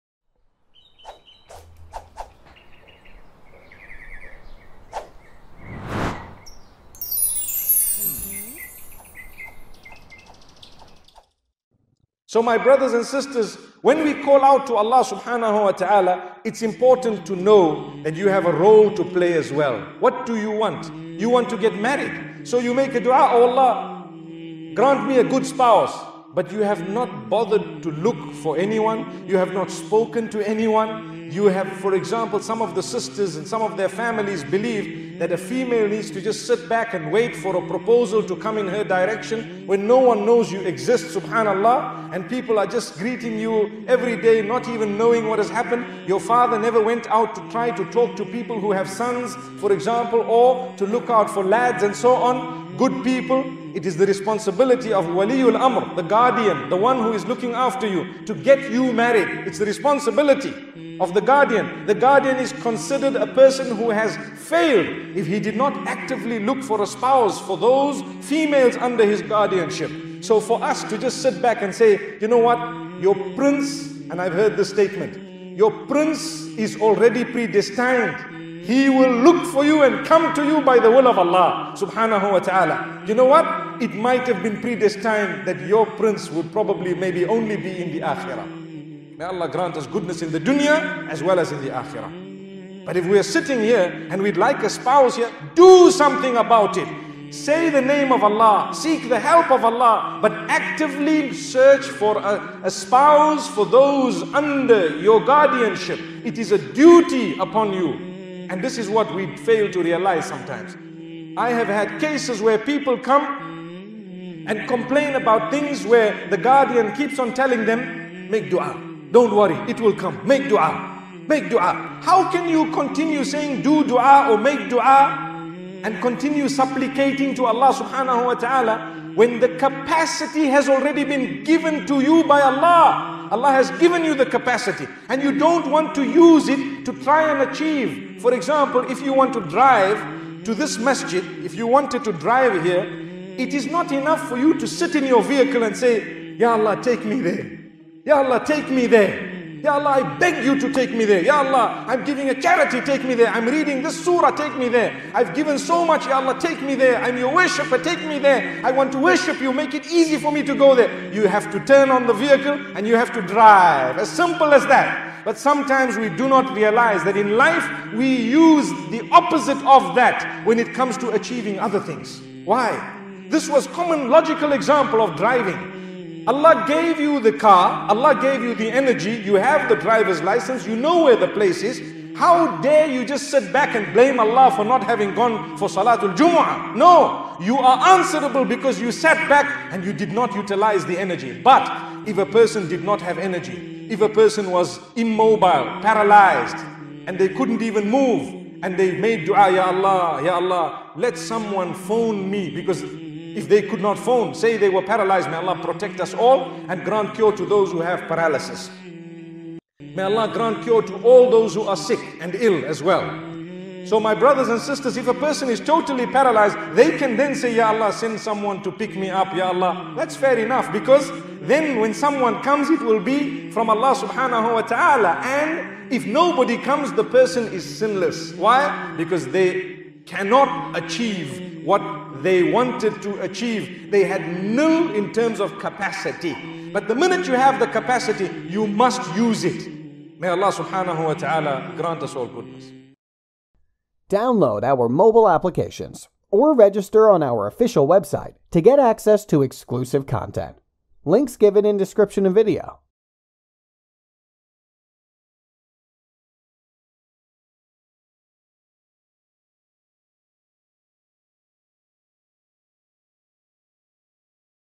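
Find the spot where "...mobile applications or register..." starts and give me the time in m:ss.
4:04.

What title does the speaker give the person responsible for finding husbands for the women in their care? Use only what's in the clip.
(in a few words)
Waliul Amr.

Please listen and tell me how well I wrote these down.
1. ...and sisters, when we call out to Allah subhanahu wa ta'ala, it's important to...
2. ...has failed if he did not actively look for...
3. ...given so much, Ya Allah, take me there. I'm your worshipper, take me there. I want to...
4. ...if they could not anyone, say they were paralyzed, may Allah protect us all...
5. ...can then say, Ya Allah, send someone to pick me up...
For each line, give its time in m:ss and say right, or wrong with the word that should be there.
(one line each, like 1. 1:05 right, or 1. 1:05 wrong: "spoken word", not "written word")
1. 0:12 right
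2. 1:03 right
3. 2:35 right
4. 3:23 wrong: "phone", not "anyone"
5. 3:36 right.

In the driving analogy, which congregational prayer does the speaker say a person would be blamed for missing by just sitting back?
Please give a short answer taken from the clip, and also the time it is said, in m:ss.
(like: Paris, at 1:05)
Salatul Jumu'ah, at 3:05.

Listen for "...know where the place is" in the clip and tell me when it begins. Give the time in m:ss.
3:00.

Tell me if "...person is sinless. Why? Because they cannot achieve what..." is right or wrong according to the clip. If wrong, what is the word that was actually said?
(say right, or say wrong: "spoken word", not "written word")
right.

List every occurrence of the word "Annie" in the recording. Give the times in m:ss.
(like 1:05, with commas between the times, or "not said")
not said.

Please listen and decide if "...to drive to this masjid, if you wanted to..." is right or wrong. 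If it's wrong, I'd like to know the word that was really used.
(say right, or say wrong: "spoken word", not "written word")
right.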